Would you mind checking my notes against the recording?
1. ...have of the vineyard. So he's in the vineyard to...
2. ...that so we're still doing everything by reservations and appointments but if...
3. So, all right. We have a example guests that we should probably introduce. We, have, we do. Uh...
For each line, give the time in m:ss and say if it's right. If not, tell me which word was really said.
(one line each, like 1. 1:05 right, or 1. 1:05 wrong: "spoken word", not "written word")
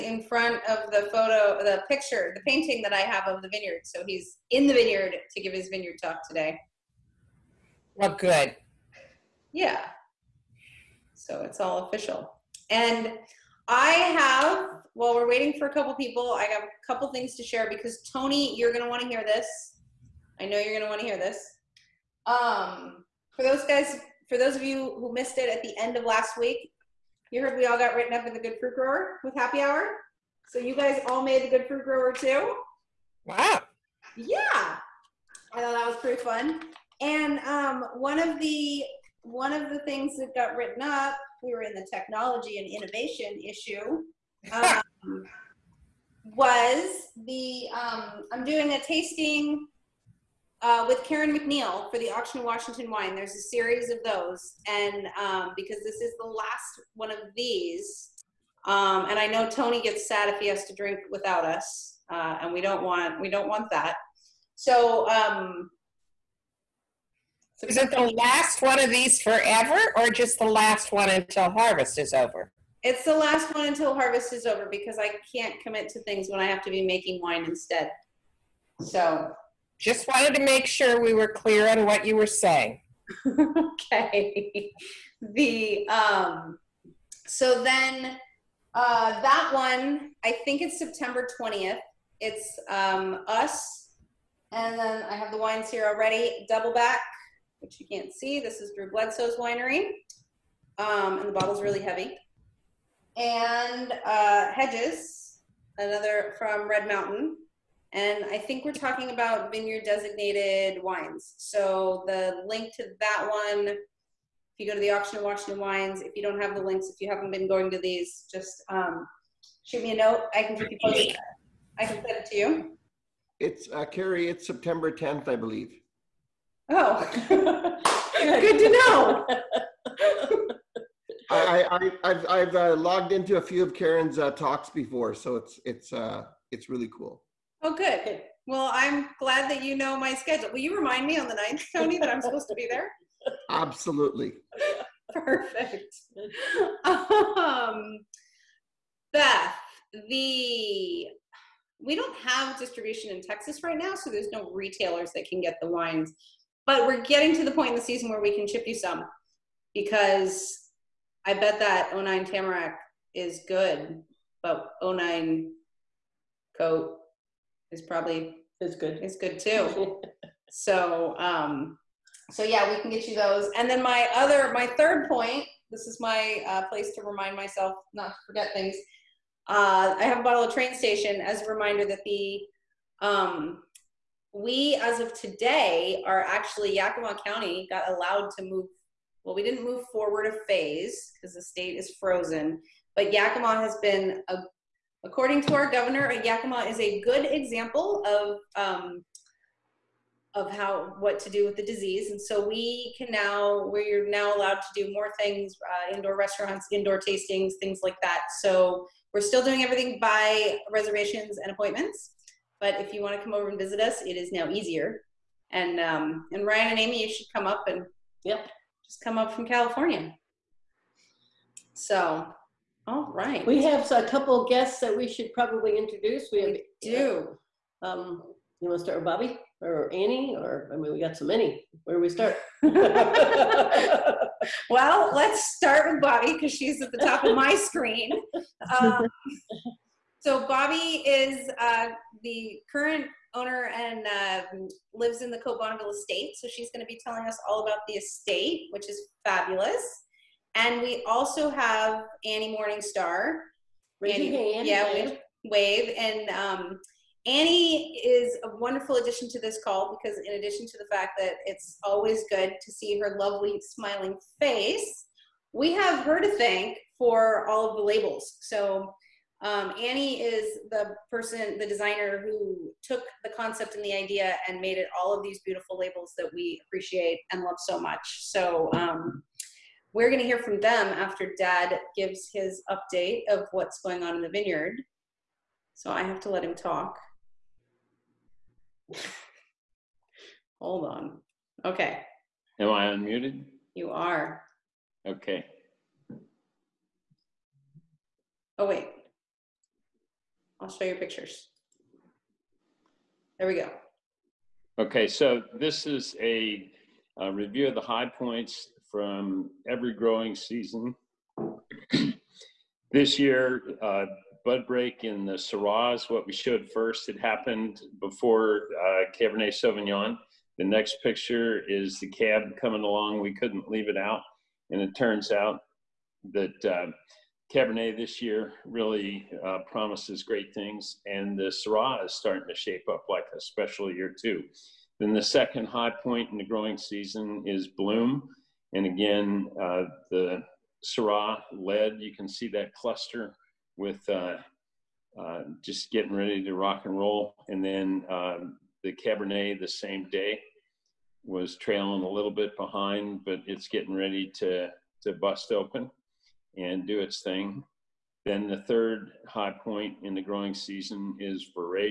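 1. 0:02 right
2. 3:28 right
3. 3:41 wrong: "couple", not "example".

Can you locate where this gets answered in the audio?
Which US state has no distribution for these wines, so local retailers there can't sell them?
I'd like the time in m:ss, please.
2:33.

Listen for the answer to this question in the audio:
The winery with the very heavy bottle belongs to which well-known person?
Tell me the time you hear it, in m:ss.
1:38.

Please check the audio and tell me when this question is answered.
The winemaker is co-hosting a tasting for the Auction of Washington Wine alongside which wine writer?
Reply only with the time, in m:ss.
0:51.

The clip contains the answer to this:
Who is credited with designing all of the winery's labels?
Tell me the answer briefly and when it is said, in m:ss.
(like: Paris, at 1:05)
Annie Morningstar, at 4:12.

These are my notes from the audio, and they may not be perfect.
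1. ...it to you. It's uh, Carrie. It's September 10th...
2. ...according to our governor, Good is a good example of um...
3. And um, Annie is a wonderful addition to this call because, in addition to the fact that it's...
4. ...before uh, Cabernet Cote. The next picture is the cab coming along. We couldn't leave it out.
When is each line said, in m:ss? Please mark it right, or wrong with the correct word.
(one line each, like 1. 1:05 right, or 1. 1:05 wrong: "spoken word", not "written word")
1. 2:02 right
2. 3:15 wrong: "Yakima", not "Good"
3. 4:15 right
4. 5:17 wrong: "Sauvignon", not "Cote".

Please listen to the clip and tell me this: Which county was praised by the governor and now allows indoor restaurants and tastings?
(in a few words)
Yakima County.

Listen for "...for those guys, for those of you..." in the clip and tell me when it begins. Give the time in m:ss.
0:23.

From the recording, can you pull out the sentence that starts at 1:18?
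So just wanted to make sure we were clear on what you were saying.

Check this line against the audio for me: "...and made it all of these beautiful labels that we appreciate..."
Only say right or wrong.
right.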